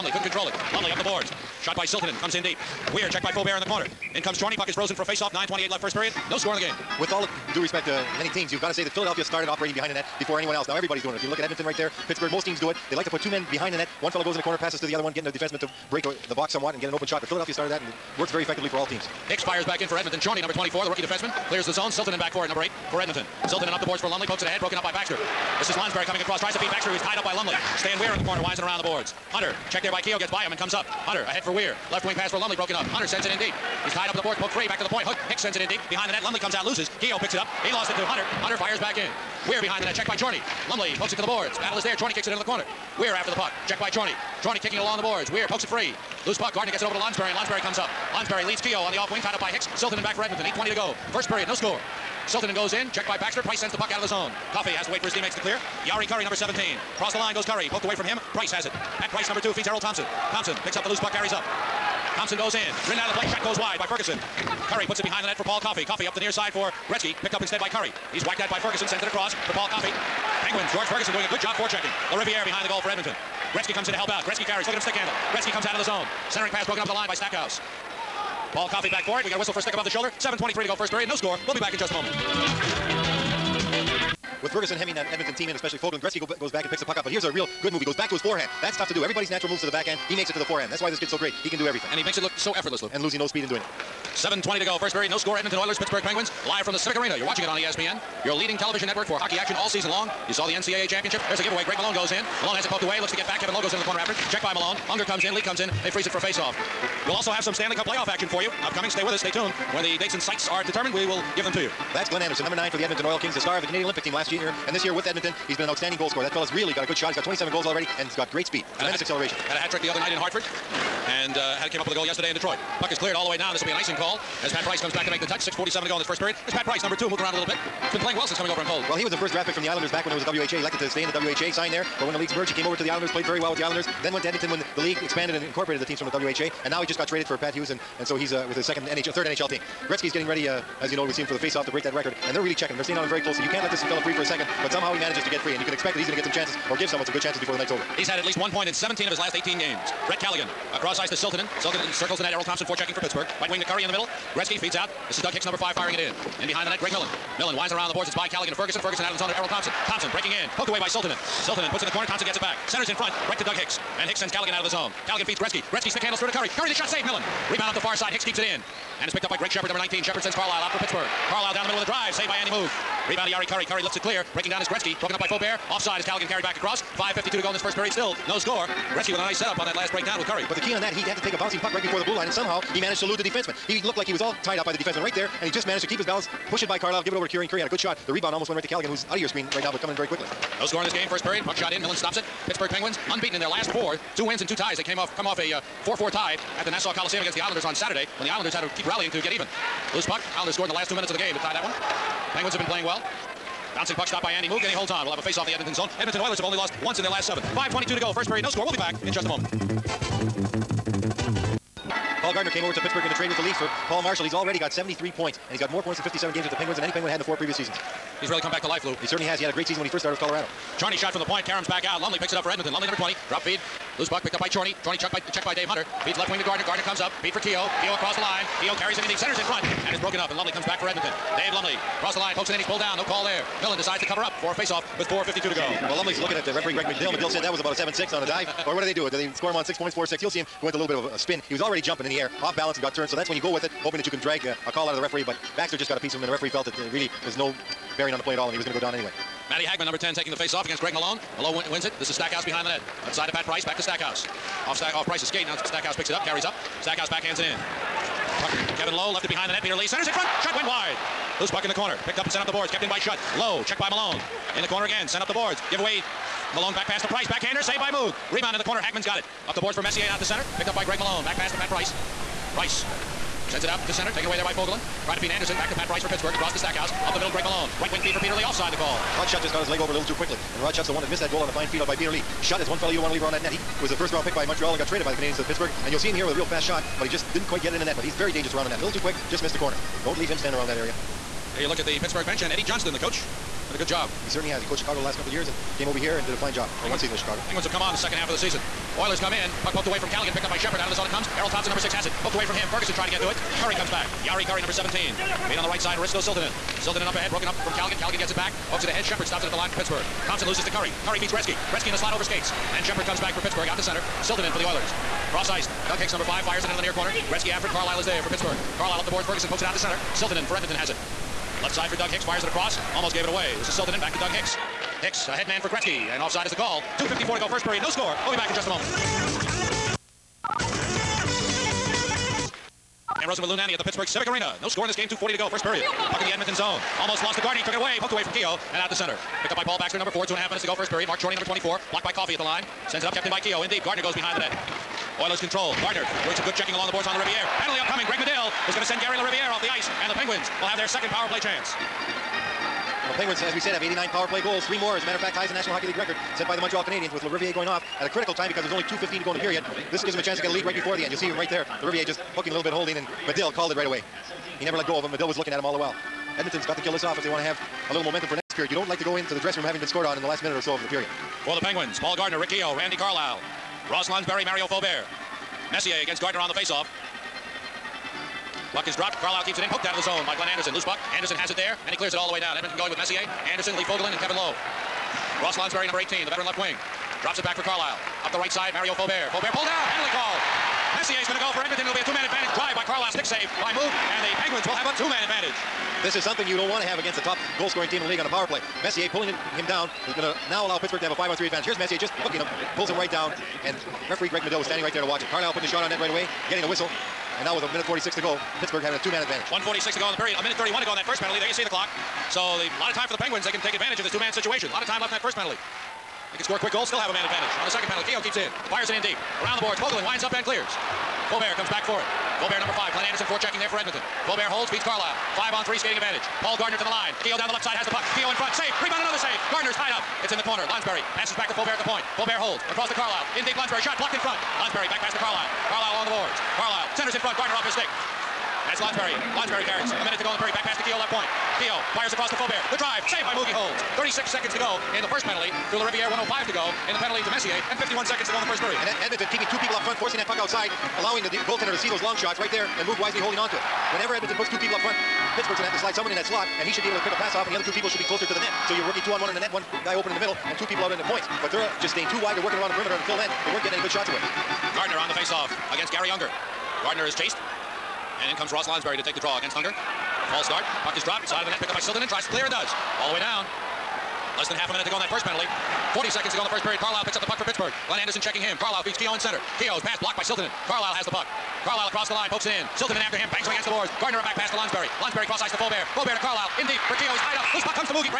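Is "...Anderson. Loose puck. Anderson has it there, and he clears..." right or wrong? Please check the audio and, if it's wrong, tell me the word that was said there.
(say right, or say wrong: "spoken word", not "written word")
right.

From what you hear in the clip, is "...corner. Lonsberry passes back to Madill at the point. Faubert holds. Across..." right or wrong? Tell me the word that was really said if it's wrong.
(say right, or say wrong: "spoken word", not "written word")
wrong: "Faubert", not "Madill".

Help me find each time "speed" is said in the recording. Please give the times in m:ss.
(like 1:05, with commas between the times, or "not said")
1:33, 1:58.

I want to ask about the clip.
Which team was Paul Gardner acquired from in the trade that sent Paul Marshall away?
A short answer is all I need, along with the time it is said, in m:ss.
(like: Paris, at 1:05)
the Leafs, at 3:33.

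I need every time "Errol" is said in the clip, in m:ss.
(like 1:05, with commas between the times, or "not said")
0:59, 2:32, 2:39, 5:01.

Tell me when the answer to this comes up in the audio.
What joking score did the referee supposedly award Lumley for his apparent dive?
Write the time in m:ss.
3:57.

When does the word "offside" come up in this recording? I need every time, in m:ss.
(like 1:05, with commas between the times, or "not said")
2:55, 4:38, 5:26.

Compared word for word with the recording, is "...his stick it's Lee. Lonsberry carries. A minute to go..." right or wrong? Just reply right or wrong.
wrong.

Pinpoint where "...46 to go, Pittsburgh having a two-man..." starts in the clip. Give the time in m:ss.
6:47.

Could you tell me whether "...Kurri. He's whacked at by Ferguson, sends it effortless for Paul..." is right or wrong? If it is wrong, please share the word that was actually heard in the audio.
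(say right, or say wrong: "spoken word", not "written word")
wrong: "across", not "effortless".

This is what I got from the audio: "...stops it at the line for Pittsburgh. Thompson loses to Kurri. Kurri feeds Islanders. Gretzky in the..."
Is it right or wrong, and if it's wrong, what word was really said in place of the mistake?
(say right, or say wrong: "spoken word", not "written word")
wrong: "Gretzky", not "Islanders".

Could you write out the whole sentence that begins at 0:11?
If you look at Edmonton right there, Pittsburgh, most teams do it.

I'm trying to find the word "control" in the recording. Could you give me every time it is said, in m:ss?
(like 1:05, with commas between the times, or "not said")
0:00, 5:45.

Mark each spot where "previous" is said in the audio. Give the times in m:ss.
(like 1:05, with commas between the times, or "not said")
3:37.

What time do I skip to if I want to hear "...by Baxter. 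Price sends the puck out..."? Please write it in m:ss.
0:53.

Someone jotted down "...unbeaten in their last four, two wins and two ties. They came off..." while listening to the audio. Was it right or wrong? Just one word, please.
right.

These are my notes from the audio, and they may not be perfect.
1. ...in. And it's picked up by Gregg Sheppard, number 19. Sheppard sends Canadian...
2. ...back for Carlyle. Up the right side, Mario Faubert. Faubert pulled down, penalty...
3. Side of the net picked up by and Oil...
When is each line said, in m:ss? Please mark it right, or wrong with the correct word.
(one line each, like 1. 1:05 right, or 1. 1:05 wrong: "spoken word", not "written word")
1. 2:48 wrong: "Carlyle", not "Canadian"
2. 6:27 right
3. 7:51 wrong: "Tries", not "Oil".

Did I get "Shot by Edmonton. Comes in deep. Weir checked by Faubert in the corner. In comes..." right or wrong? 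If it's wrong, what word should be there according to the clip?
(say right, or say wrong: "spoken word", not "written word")
wrong: "Siltanen", not "Edmonton".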